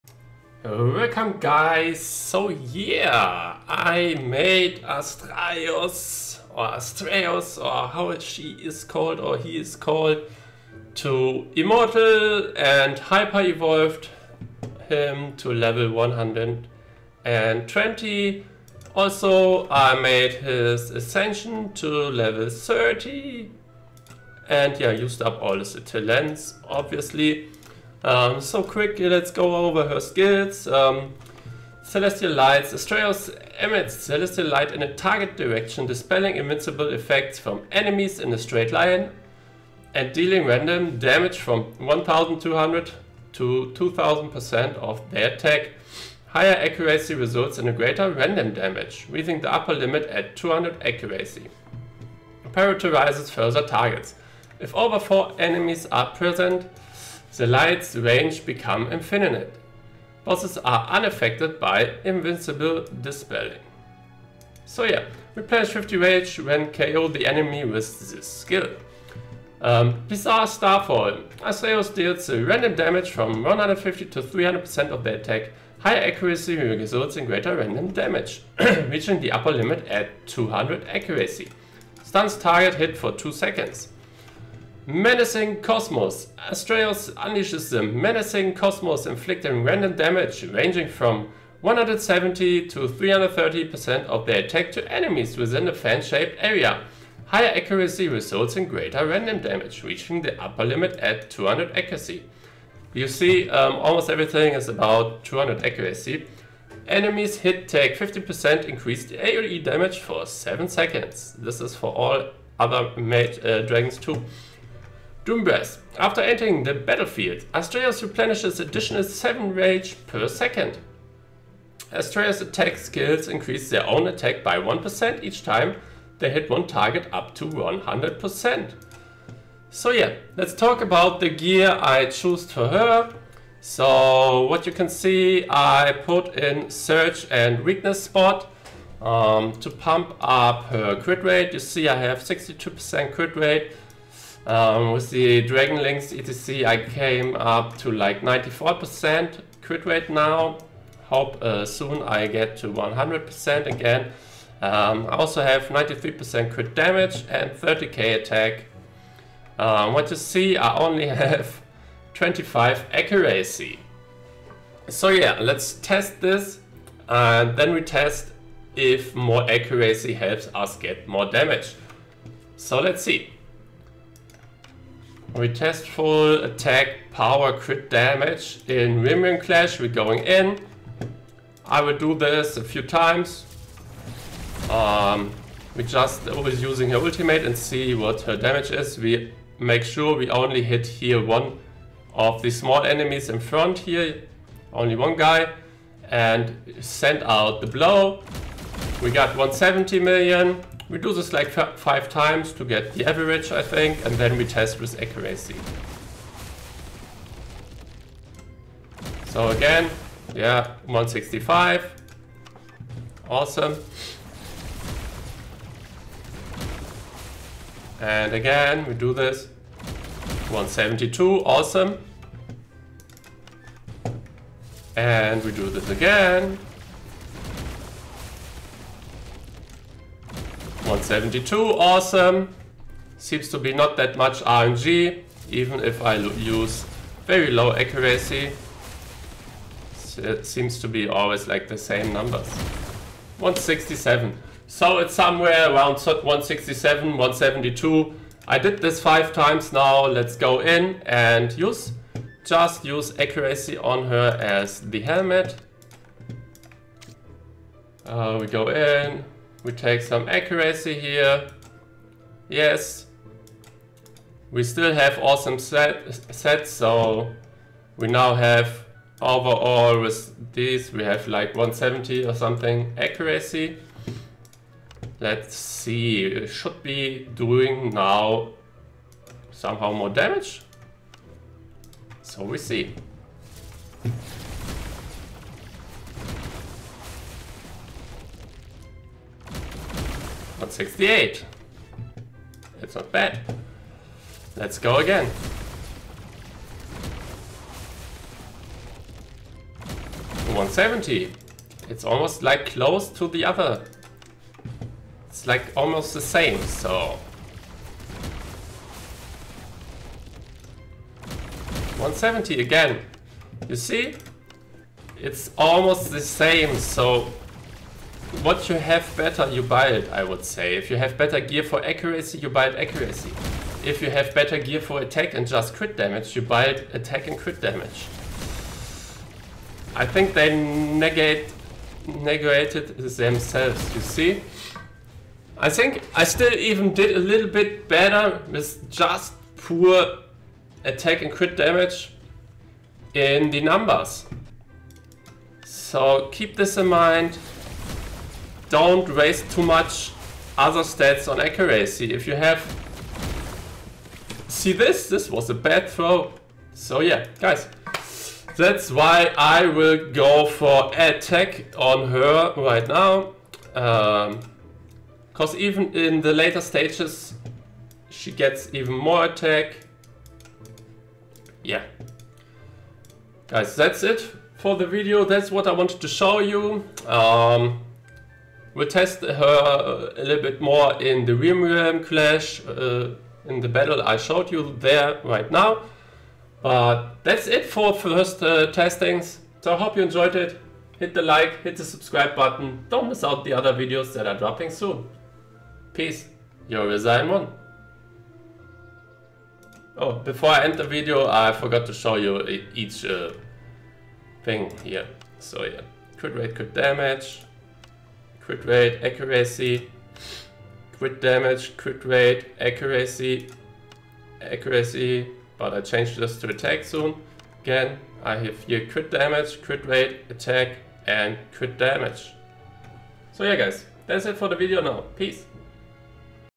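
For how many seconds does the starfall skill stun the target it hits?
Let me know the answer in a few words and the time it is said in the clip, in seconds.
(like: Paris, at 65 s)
2 seconds, at 83 s.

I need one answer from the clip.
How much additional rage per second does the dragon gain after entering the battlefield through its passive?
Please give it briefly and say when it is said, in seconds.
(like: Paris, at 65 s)
7, at 118 s.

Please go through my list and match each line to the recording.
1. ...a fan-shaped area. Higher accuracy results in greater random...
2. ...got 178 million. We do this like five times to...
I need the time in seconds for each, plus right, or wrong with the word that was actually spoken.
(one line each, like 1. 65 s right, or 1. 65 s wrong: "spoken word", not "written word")
1. 95 s right
2. 199 s wrong: "170", not "178".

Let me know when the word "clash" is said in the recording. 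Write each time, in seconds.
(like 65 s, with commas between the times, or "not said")
179 s, 382 s.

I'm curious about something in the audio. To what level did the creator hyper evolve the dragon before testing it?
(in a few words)
120.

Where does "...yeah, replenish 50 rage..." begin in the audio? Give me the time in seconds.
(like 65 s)
64 s.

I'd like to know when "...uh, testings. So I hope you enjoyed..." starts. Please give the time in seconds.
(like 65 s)
388 s.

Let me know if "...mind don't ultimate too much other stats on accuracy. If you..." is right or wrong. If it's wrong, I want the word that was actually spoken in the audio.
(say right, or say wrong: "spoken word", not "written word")
wrong: "waste", not "ultimate".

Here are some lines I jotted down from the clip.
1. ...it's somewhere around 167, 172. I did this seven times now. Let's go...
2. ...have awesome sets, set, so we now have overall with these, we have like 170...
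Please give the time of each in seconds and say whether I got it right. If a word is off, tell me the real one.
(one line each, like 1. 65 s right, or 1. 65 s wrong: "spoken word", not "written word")
1. 244 s wrong: "five", not "seven"
2. 264 s right.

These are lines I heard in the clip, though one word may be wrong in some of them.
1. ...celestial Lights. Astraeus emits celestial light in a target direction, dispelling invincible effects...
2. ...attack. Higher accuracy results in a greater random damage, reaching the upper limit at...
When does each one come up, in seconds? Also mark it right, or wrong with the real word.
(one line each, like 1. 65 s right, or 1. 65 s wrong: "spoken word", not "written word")
1. 31 s right
2. 45 s right.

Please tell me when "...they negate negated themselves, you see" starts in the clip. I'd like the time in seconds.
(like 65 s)
330 s.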